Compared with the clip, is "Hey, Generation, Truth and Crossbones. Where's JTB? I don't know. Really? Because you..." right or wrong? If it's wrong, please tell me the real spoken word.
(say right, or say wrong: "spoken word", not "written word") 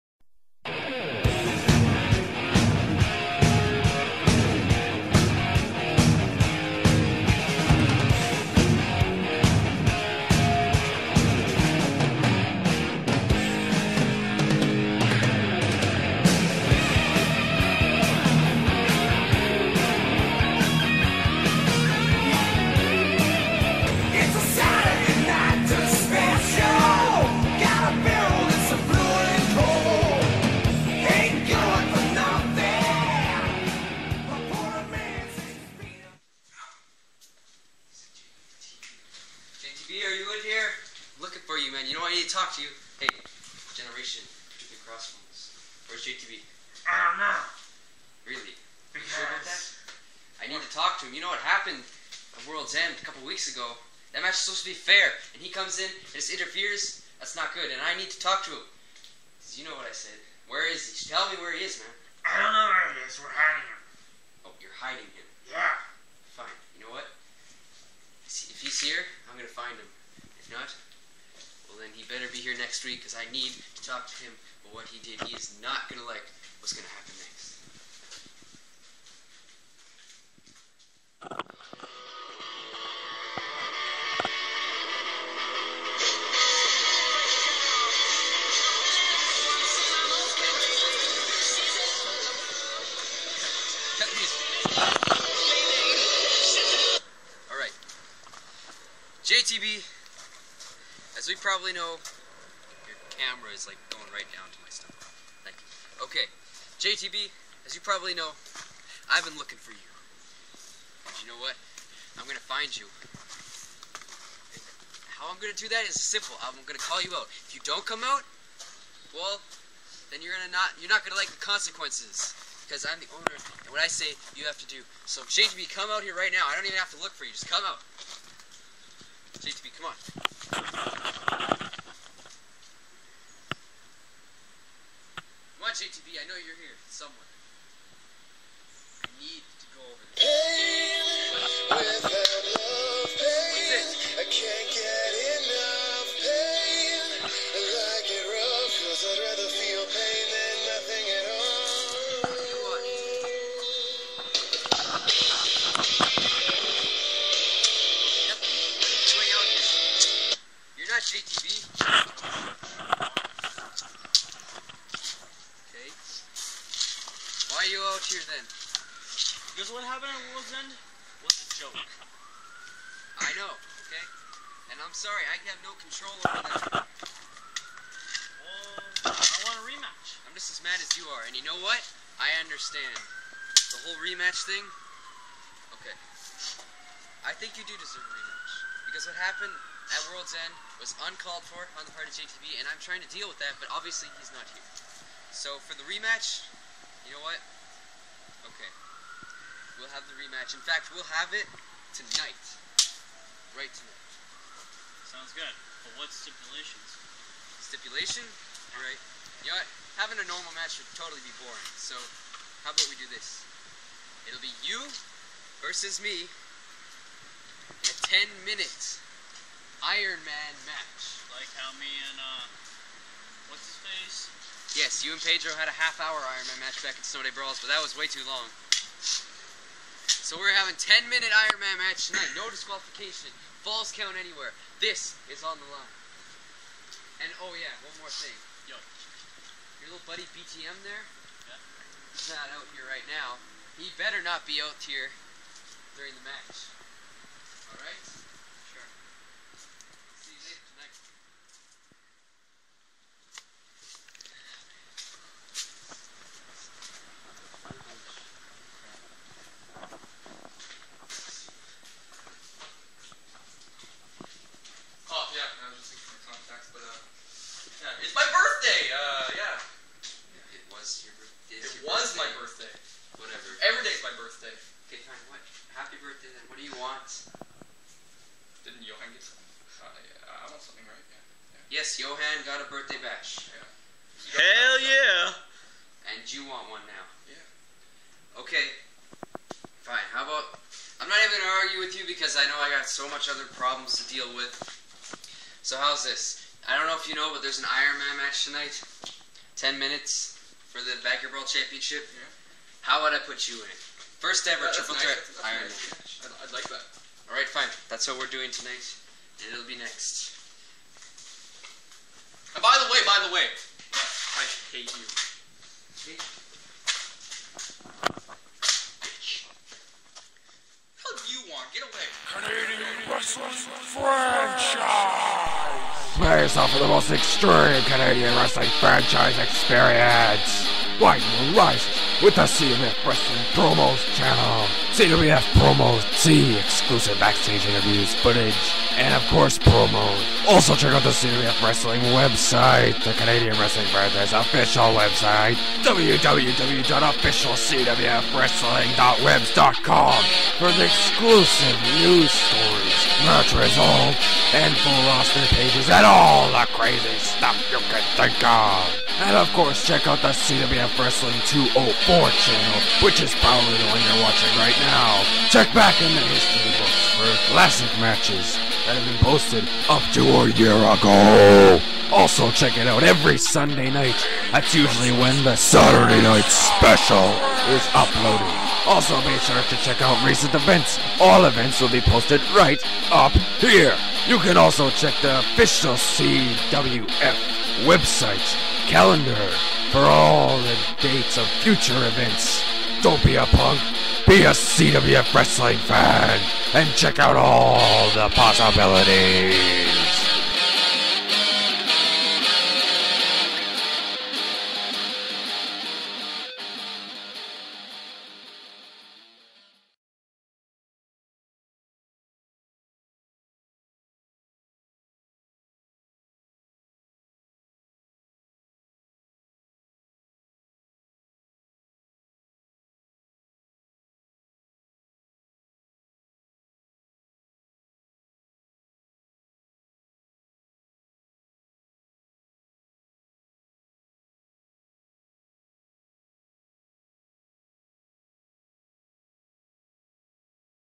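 right.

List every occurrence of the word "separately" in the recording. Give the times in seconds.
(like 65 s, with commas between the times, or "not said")
not said.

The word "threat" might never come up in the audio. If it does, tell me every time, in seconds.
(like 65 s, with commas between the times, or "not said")
305 s.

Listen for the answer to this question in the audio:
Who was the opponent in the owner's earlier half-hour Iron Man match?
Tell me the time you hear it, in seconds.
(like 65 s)
225 s.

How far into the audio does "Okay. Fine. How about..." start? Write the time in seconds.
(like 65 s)
288 s.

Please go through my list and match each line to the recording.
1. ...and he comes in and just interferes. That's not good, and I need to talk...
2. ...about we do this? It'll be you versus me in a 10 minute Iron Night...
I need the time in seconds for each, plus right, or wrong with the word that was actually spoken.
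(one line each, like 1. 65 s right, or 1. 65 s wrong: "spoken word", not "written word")
1. 55 s right
2. 212 s wrong: "Man", not "Night".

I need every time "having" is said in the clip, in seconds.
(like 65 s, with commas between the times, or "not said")
209 s, 230 s.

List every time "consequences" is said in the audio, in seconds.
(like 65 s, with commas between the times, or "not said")
121 s.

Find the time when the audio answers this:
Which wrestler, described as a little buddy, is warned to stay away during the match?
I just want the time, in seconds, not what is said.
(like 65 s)
240 s.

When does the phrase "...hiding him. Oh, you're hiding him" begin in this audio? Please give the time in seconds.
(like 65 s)
63 s.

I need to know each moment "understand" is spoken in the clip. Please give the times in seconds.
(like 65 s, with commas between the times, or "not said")
182 s.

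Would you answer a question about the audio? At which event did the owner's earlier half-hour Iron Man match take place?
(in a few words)
Snow Day Brawls.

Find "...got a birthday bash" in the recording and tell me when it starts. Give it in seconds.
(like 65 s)
282 s.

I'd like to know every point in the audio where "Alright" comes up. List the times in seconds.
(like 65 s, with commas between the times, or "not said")
208 s, 247 s.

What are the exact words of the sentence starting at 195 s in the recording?
So for the rematch, you know what?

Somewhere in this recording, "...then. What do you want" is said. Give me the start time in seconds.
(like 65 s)
276 s.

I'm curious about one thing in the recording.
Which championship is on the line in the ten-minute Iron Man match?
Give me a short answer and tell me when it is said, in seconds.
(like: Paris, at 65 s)
Backyard Brawl Championship, at 301 s.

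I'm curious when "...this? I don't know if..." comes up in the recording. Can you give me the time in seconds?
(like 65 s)
296 s.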